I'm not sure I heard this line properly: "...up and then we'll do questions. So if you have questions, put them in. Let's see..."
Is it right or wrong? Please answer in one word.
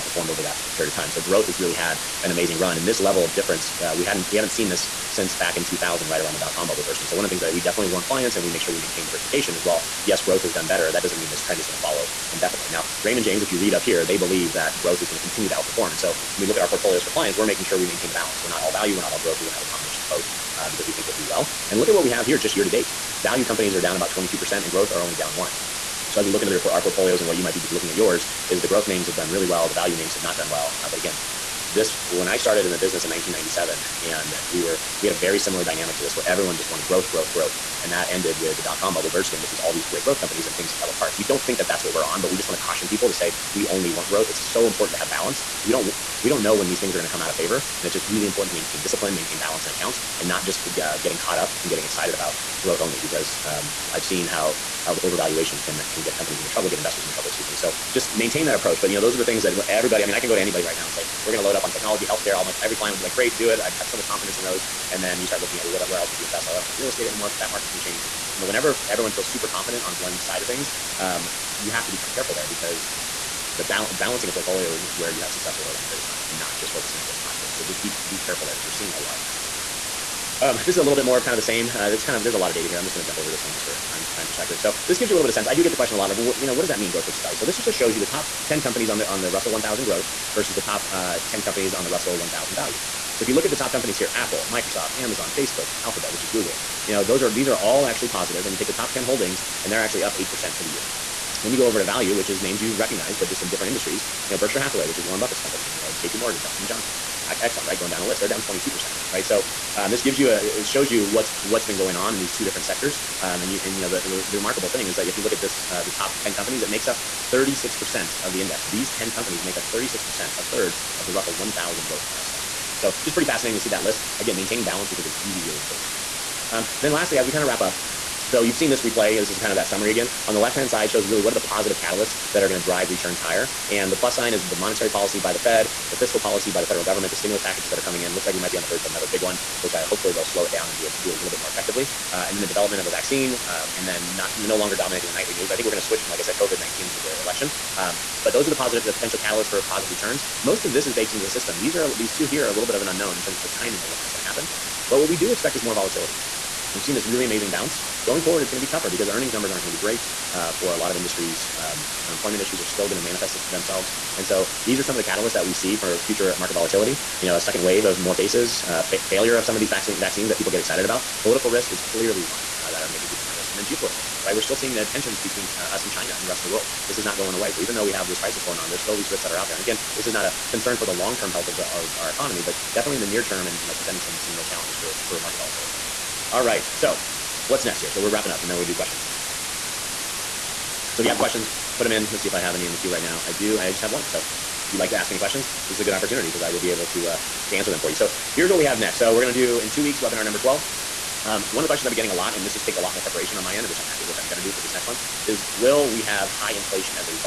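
right.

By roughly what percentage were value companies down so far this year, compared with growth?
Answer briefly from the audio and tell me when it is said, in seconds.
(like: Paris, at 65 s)
22%, at 23 s.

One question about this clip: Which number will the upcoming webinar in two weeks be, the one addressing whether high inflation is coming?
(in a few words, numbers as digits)
12.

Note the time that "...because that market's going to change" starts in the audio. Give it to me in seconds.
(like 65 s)
67 s.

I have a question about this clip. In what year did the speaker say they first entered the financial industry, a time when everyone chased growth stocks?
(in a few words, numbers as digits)
1997.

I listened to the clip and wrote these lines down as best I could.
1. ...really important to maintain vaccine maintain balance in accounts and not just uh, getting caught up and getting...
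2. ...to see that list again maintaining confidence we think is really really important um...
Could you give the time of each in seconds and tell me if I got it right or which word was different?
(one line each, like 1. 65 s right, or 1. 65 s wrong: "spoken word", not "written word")
1. 48 s wrong: "discipline", not "vaccine"
2. 123 s wrong: "balance", not "confidence".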